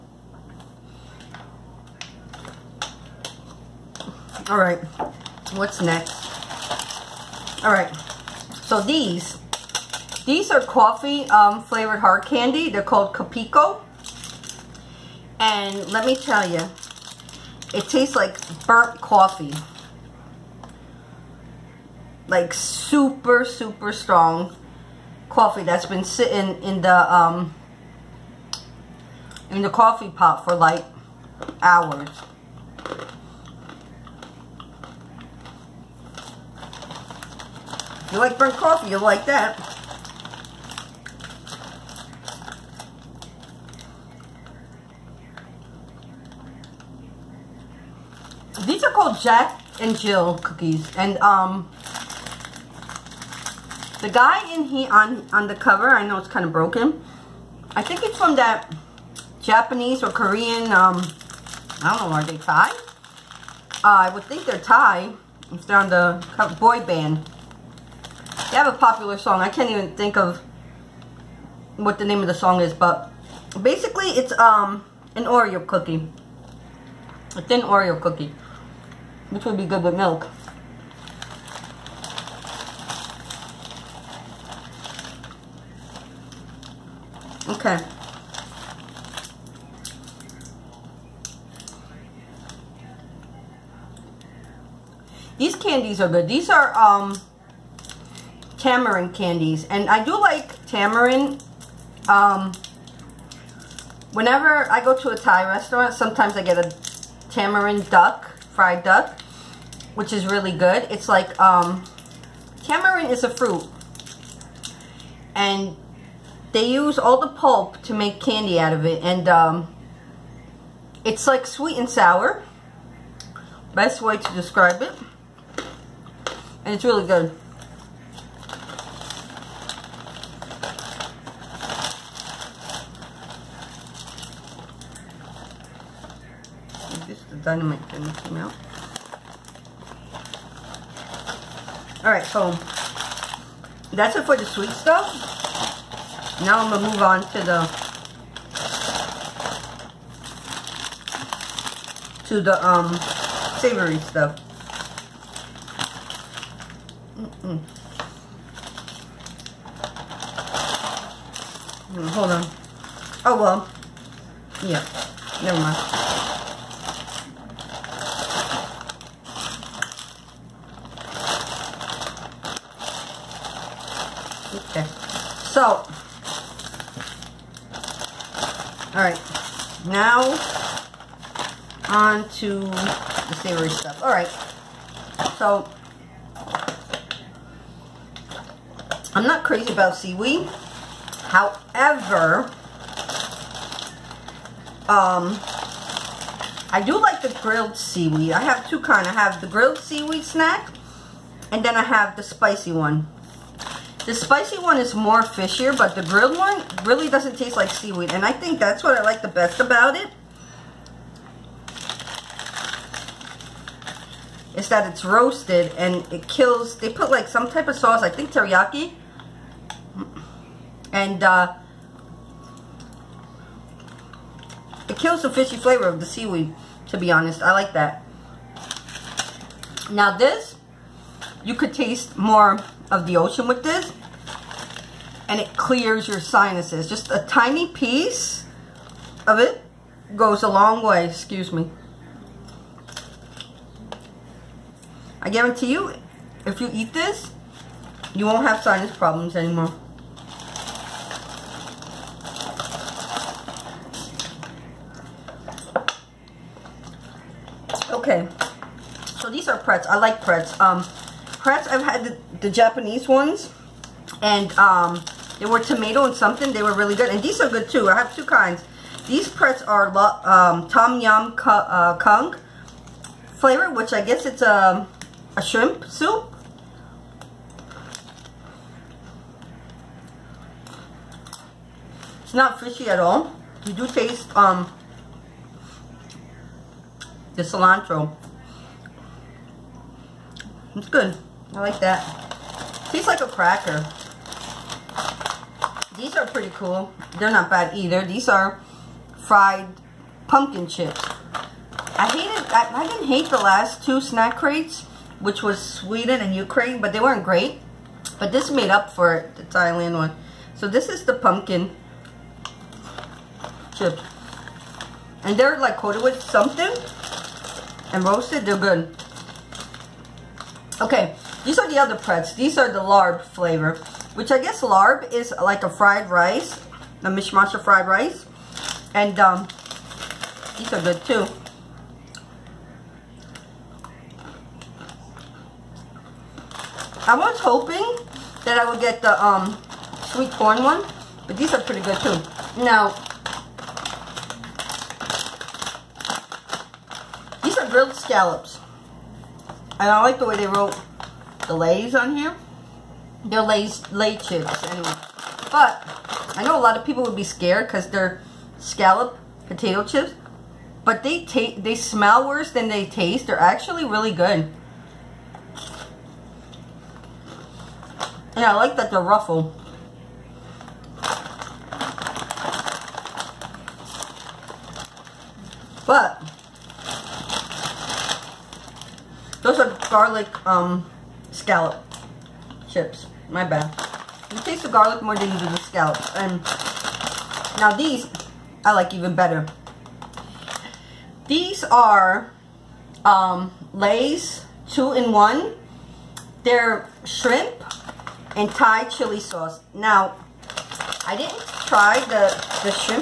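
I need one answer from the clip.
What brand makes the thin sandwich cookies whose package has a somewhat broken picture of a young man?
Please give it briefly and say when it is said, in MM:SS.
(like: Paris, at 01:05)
Jack and Jill, at 00:49.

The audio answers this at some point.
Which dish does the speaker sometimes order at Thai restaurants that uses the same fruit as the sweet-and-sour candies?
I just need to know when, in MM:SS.
01:47.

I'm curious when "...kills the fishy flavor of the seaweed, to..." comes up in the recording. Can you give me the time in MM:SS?
03:44.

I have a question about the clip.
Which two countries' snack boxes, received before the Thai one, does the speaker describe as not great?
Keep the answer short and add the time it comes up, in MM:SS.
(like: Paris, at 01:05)
Sweden and Ukraine, at 05:05.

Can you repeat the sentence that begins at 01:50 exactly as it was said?
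It's like, um, tamarind is a fruit.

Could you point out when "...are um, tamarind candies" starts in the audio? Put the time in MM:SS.
01:36.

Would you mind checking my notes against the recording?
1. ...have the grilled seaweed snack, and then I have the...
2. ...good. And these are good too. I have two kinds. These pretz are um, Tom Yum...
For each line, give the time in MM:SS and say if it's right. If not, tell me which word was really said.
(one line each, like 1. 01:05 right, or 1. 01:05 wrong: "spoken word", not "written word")
1. 03:19 right
2. 04:26 right.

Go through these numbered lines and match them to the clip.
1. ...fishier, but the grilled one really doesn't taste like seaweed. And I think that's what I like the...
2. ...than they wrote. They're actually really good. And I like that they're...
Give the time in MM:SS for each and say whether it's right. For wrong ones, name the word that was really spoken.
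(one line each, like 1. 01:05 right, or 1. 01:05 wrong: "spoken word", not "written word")
1. 03:25 right
2. 06:02 wrong: "taste", not "wrote".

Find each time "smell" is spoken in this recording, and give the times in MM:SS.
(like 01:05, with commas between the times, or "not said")
06:01.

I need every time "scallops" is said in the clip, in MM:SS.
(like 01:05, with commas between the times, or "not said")
05:47, 05:58, 06:21, 06:25.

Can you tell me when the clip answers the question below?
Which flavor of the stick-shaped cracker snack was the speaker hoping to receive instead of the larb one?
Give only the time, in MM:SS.
05:40.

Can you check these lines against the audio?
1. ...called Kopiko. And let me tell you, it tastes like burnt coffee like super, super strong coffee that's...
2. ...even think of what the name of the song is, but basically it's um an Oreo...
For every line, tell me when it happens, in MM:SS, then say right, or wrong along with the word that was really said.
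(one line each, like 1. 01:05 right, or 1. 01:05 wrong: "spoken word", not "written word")
1. 00:12 right
2. 01:09 right.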